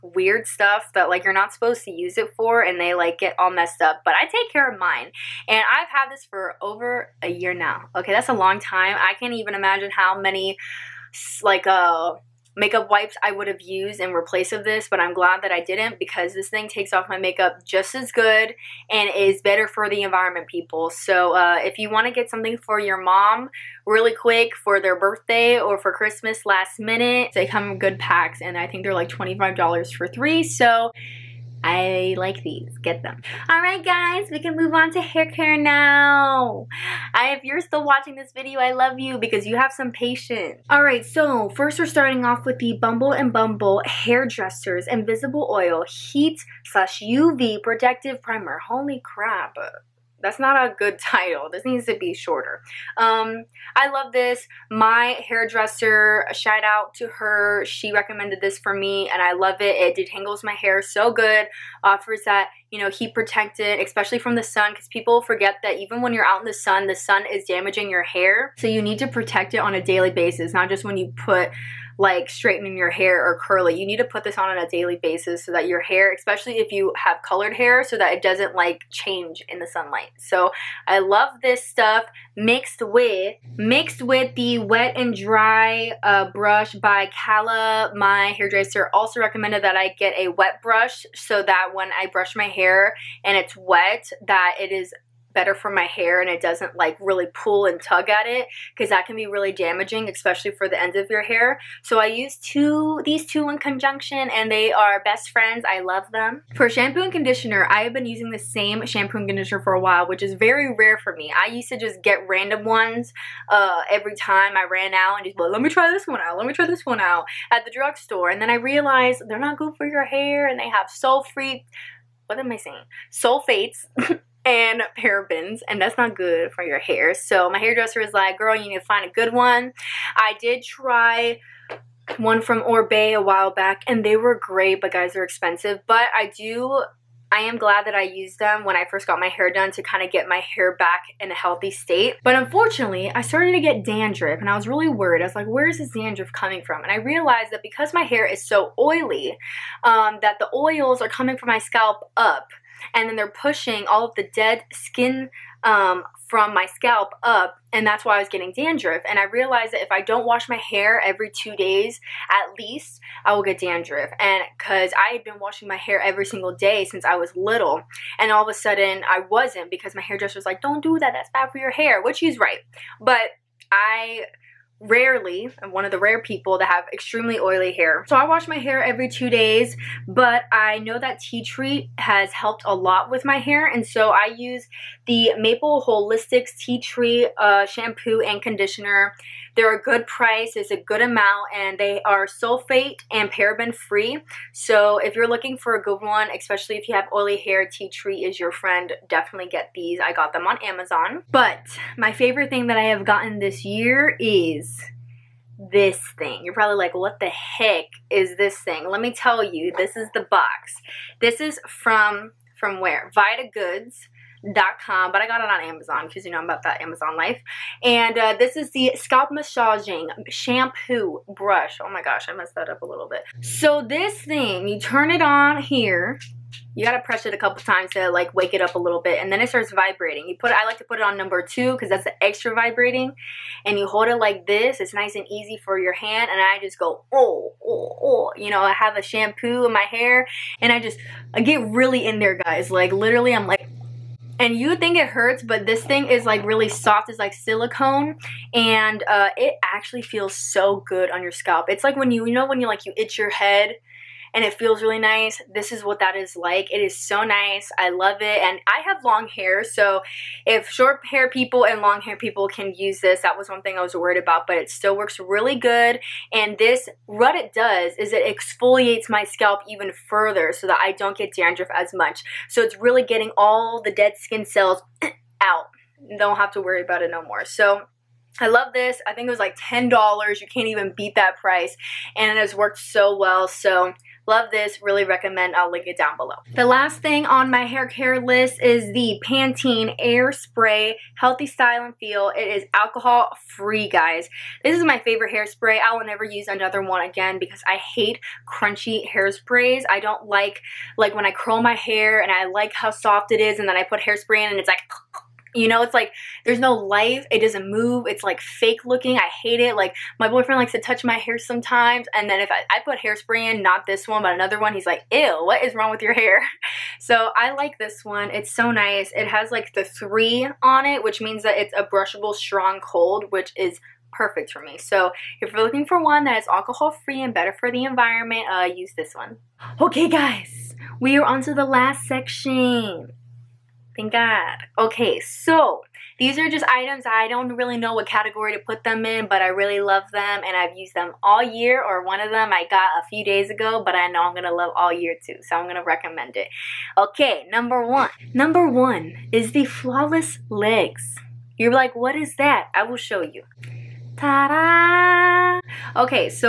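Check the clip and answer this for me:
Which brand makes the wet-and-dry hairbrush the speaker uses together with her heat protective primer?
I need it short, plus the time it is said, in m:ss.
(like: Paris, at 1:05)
Kala, at 1:27.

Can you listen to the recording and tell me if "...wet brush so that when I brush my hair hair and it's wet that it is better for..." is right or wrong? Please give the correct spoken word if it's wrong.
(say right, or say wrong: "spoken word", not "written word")
right.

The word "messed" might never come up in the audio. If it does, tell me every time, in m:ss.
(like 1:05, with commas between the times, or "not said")
0:03, 3:42.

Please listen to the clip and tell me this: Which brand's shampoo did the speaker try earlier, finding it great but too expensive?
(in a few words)
Oribe.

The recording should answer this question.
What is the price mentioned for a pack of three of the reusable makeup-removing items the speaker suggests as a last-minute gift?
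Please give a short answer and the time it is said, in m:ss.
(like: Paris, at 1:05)
$25, at 0:29.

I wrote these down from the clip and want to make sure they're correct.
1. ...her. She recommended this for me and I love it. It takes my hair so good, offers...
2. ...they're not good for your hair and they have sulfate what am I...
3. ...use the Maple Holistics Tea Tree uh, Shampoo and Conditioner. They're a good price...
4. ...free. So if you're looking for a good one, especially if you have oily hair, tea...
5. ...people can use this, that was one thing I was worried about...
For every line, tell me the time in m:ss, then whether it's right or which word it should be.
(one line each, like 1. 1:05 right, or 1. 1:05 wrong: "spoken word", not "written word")
1. 0:57 wrong: "detangles", not "takes"
2. 1:59 right
3. 3:04 right
4. 3:13 right
5. 4:22 right.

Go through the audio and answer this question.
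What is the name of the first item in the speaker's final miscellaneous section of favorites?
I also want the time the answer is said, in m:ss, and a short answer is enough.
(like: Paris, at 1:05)
Flawless Legs, at 5:49.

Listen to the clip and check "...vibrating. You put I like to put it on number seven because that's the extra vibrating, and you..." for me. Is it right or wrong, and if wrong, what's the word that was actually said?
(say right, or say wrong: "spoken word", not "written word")
wrong: "two", not "seven".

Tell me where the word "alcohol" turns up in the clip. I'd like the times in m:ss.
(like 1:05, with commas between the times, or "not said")
4:52, 5:26.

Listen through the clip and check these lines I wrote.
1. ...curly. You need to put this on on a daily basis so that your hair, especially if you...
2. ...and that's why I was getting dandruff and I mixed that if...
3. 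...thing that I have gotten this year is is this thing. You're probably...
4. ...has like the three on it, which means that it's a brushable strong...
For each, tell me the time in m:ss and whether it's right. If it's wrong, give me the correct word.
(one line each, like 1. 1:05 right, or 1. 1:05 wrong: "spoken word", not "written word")
1. 1:13 right
2. 2:37 wrong: "realized", not "mixed"
3. 3:22 right
4. 5:19 right.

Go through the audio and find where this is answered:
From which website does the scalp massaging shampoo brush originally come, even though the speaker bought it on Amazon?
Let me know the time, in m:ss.
3:33.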